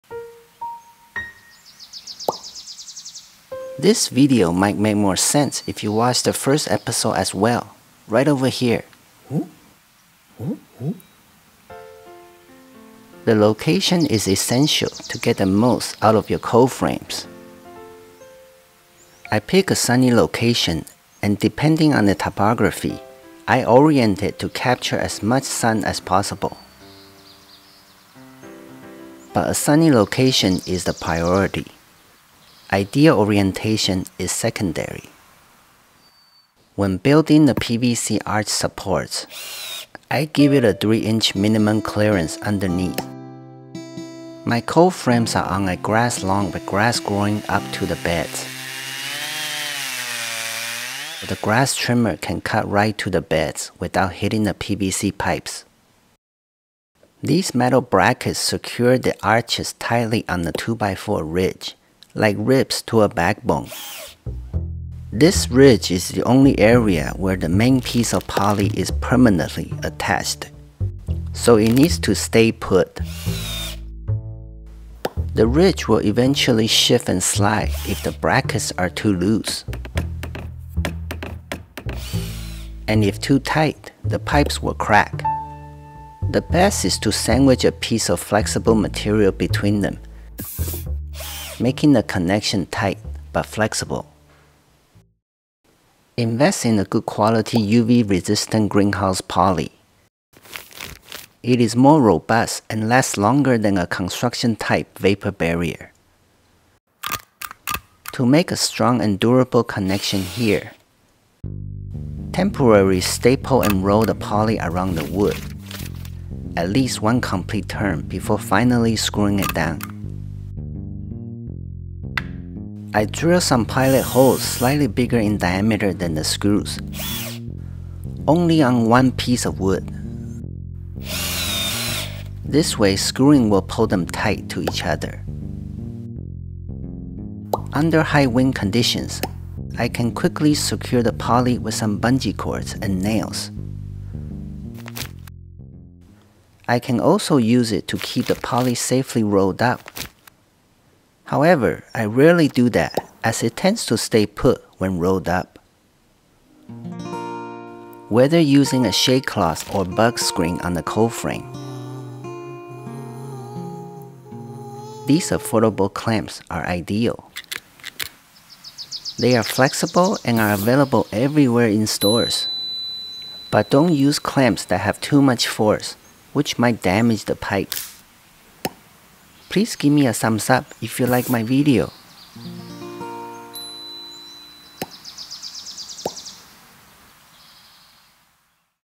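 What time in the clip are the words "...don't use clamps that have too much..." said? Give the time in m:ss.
2:53.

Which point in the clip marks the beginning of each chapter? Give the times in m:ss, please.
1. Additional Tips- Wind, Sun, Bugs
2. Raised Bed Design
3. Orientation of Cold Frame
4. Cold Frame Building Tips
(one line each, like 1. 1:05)
1. 2:16
2. 0:36
3. 0:12
4. 0:56.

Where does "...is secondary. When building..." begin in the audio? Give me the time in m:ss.
0:34.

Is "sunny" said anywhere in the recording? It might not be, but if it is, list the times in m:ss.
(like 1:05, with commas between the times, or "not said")
0:19, 0:29.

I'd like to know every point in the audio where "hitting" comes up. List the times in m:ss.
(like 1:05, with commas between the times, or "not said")
0:54.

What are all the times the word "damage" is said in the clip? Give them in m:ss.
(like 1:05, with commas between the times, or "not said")
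2:56.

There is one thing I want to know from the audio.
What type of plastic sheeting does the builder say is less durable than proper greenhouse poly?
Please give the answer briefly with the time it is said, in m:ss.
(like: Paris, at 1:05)
construction type vapor barrier, at 1:43.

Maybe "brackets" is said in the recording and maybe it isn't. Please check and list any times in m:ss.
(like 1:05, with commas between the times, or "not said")
0:57, 1:18.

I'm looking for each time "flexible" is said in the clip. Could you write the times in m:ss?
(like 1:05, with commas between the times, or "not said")
1:28, 1:33, 2:49.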